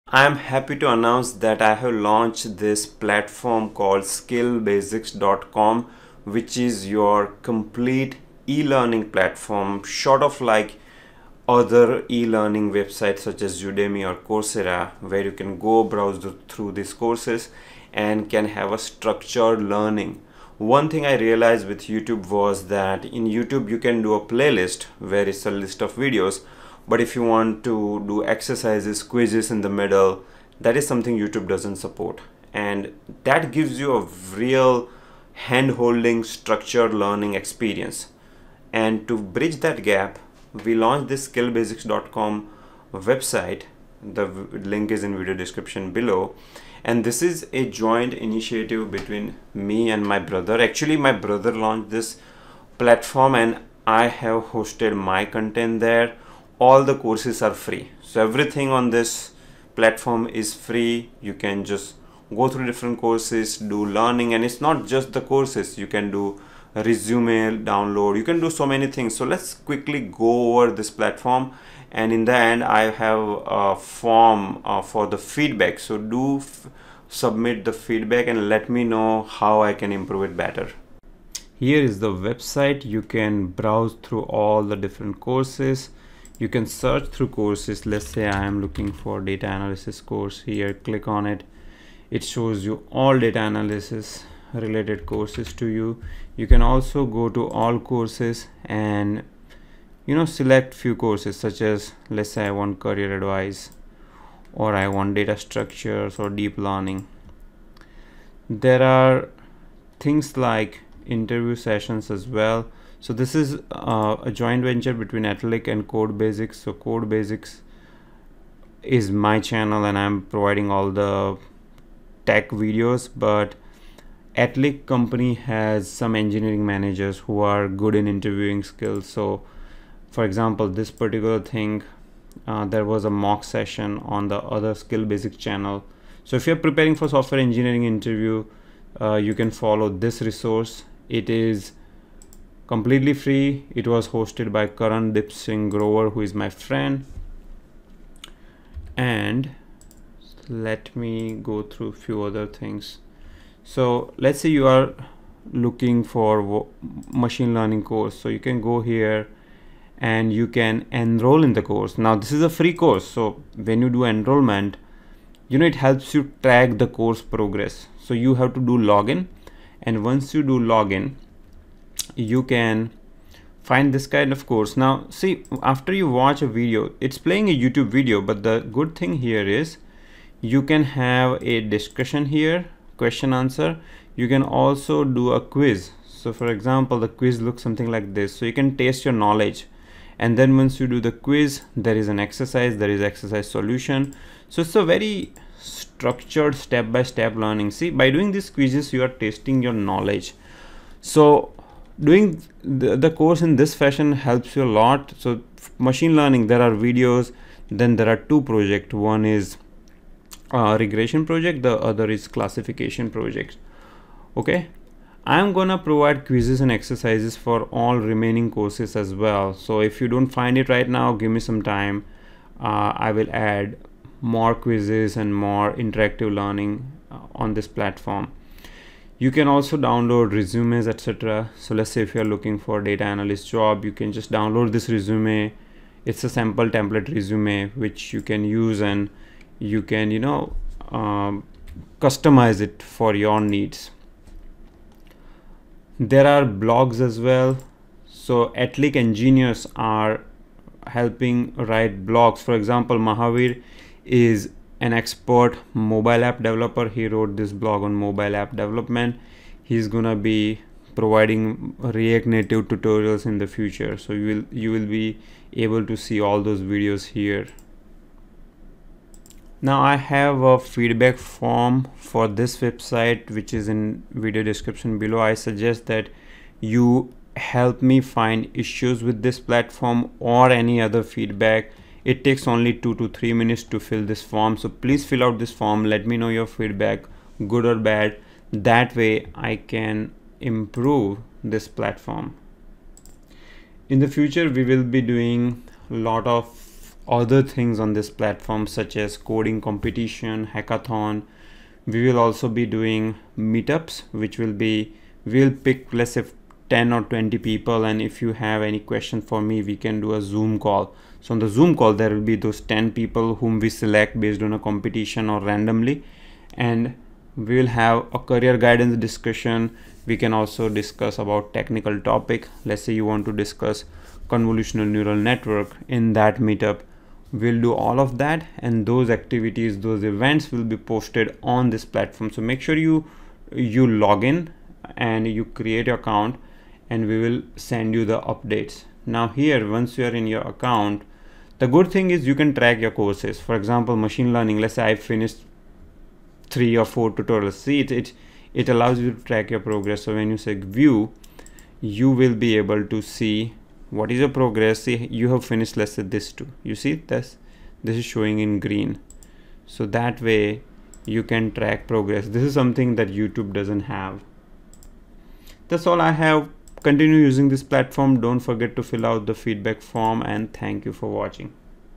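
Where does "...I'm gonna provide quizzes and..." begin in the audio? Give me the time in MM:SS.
03:35.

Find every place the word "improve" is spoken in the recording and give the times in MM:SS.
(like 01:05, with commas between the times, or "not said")
01:19, 04:50.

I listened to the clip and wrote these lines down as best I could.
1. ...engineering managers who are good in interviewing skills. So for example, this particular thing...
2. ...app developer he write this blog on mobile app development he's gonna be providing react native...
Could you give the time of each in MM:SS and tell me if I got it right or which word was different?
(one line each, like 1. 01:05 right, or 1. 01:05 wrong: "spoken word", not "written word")
1. 02:06 right
2. 04:16 wrong: "wrote", not "write".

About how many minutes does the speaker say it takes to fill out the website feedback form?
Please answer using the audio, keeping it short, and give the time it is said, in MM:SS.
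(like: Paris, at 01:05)
2 to 3 minutes, at 04:42.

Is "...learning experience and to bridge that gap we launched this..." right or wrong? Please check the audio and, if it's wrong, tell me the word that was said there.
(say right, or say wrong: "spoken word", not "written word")
right.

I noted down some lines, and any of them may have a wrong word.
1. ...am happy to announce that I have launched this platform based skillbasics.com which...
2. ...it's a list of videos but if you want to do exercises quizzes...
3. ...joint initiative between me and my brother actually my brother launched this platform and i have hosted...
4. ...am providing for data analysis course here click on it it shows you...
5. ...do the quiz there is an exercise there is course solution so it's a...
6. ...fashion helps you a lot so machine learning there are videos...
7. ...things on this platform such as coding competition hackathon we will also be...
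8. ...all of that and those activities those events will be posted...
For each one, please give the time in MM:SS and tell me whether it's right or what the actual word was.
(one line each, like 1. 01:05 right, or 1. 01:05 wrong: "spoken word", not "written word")
1. 00:00 wrong: "called", not "based"
2. 00:25 right
3. 00:47 right
4. 01:28 wrong: "looking", not "providing"
5. 03:10 wrong: "exercise", not "course"
6. 03:23 right
7. 04:57 right
8. 05:27 right.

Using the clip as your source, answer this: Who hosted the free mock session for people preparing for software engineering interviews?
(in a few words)
Karan Dip Singh Grover.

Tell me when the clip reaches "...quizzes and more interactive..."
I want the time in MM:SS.
03:44.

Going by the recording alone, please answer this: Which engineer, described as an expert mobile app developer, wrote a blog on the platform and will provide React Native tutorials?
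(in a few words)
Mahavir.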